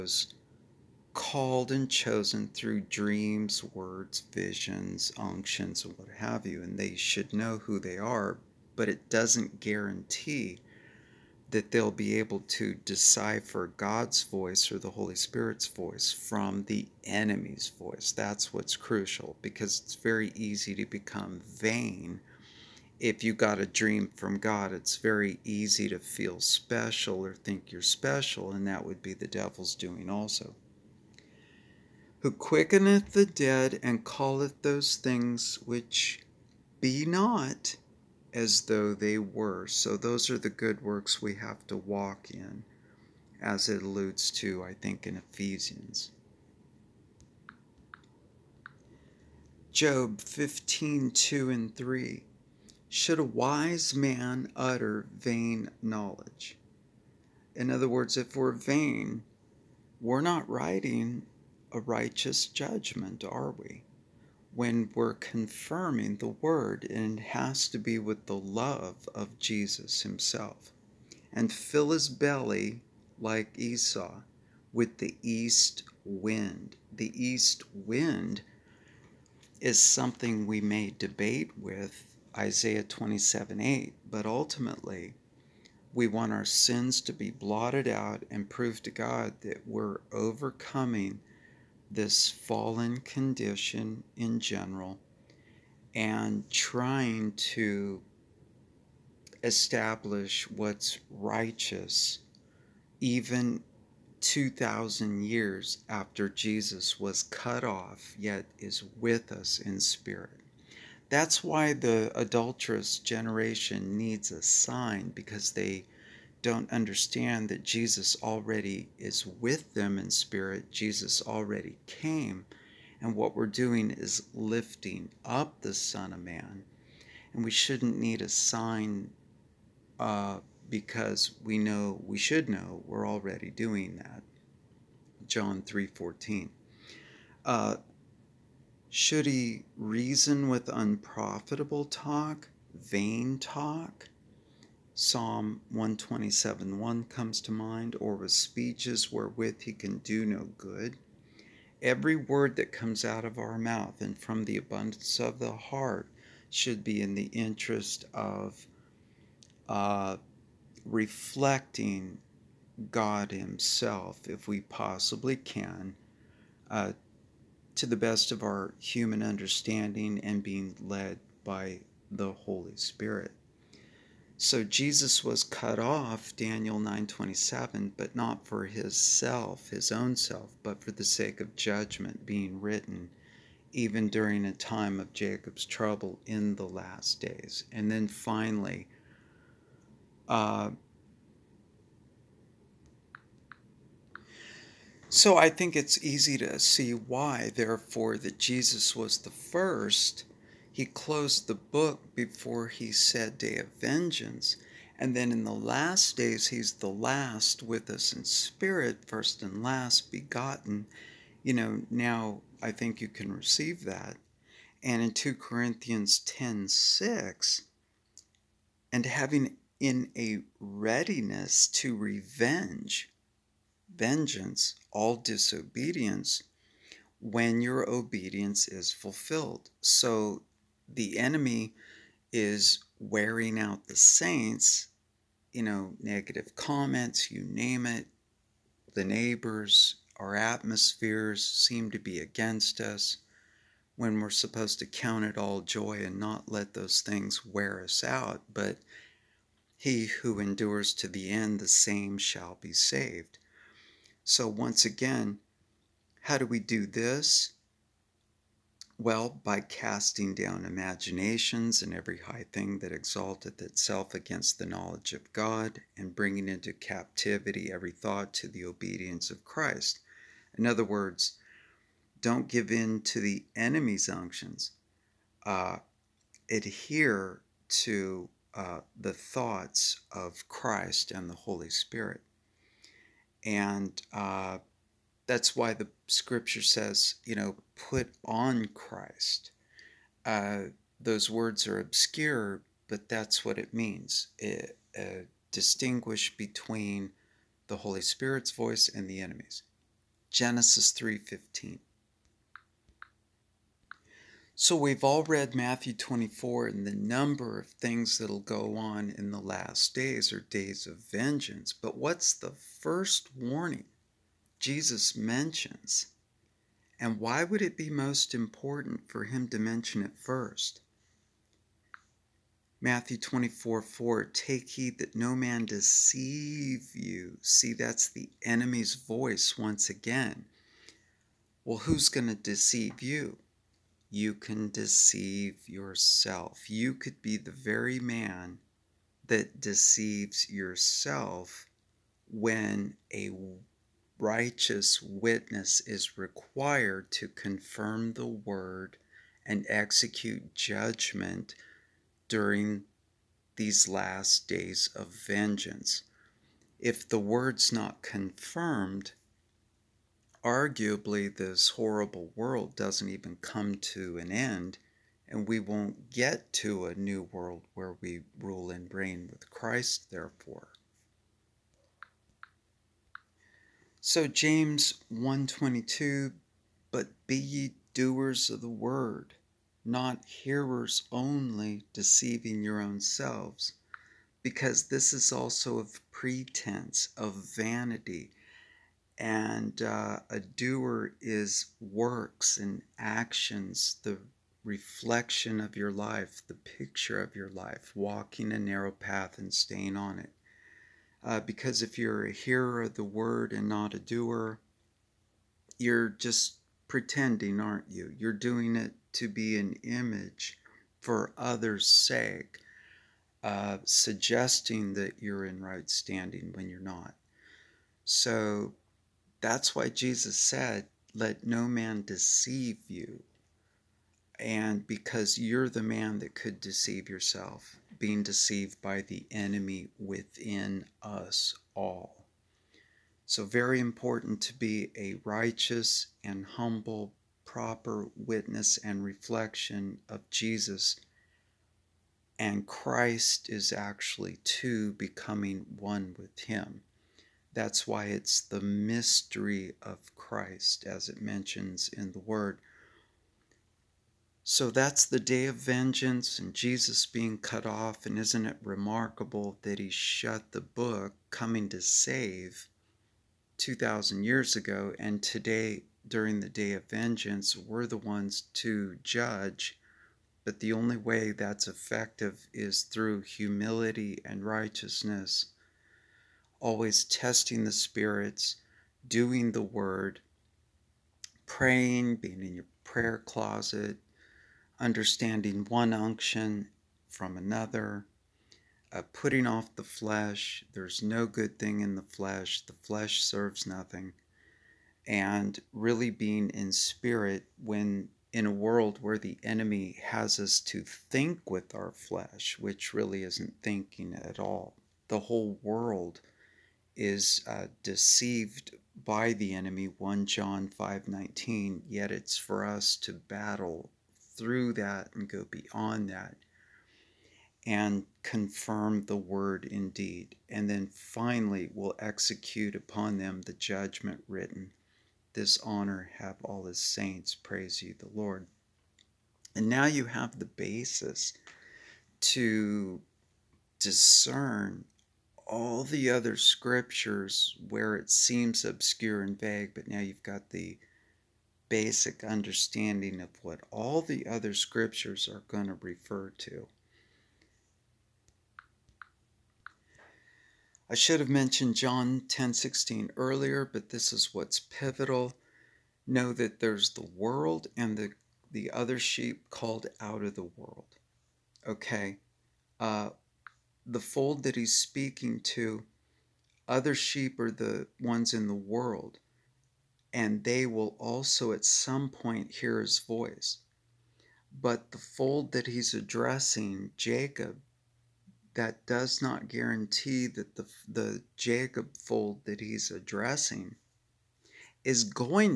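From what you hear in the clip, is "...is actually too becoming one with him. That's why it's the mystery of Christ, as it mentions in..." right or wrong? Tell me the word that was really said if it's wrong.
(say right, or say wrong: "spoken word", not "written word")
right.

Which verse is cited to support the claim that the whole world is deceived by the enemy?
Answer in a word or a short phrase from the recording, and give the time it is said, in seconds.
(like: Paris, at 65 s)
1 John 5:19, at 509 s.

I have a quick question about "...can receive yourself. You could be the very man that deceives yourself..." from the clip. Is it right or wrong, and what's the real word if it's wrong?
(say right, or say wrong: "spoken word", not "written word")
wrong: "deceive", not "receive".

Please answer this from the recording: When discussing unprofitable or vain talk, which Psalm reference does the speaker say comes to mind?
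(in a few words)
Psalm 127:1.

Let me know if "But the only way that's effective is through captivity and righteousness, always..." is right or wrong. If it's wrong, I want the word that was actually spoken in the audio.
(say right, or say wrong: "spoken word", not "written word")
wrong: "humility", not "captivity".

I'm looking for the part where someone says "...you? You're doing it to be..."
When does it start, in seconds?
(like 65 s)
407 s.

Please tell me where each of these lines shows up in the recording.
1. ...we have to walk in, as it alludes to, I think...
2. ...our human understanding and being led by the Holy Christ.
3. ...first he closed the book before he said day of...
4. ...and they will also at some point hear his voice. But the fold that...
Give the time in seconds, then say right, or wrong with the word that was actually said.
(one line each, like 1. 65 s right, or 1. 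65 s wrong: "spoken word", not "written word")
1. 41 s right
2. 168 s wrong: "Spirit", not "Christ"
3. 199 s right
4. 570 s right.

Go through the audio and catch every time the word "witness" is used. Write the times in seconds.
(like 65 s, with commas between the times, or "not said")
345 s, 438 s.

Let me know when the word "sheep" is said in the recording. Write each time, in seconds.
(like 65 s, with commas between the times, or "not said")
558 s, 566 s.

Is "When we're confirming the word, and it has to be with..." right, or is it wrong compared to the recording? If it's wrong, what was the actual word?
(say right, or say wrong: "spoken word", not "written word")
right.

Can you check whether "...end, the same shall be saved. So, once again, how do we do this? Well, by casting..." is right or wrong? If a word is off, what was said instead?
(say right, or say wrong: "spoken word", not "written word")
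right.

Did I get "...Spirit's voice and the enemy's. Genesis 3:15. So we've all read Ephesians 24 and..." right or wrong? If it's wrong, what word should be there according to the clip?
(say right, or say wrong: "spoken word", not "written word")
wrong: "Matthew", not "Ephesians".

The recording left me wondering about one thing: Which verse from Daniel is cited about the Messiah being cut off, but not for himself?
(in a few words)
Daniel 9:27.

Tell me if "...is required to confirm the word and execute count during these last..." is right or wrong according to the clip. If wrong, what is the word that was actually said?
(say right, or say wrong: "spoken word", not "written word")
wrong: "judgment", not "count".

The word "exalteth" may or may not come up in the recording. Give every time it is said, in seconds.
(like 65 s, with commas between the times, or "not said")
262 s.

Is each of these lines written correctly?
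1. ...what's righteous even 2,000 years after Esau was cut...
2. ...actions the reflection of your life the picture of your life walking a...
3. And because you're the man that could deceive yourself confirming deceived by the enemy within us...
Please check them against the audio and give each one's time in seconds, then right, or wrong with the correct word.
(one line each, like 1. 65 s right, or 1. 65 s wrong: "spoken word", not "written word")
1. 100 s wrong: "Jesus", not "Esau"
2. 392 s right
3. 424 s wrong: "being", not "confirming".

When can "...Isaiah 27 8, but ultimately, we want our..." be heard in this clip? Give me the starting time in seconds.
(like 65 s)
82 s.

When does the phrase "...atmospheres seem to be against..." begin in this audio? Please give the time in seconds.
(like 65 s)
240 s.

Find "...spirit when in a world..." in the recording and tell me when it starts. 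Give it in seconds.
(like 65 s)
496 s.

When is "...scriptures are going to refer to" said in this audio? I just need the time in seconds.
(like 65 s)
544 s.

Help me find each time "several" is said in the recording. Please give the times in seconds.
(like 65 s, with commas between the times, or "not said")
not said.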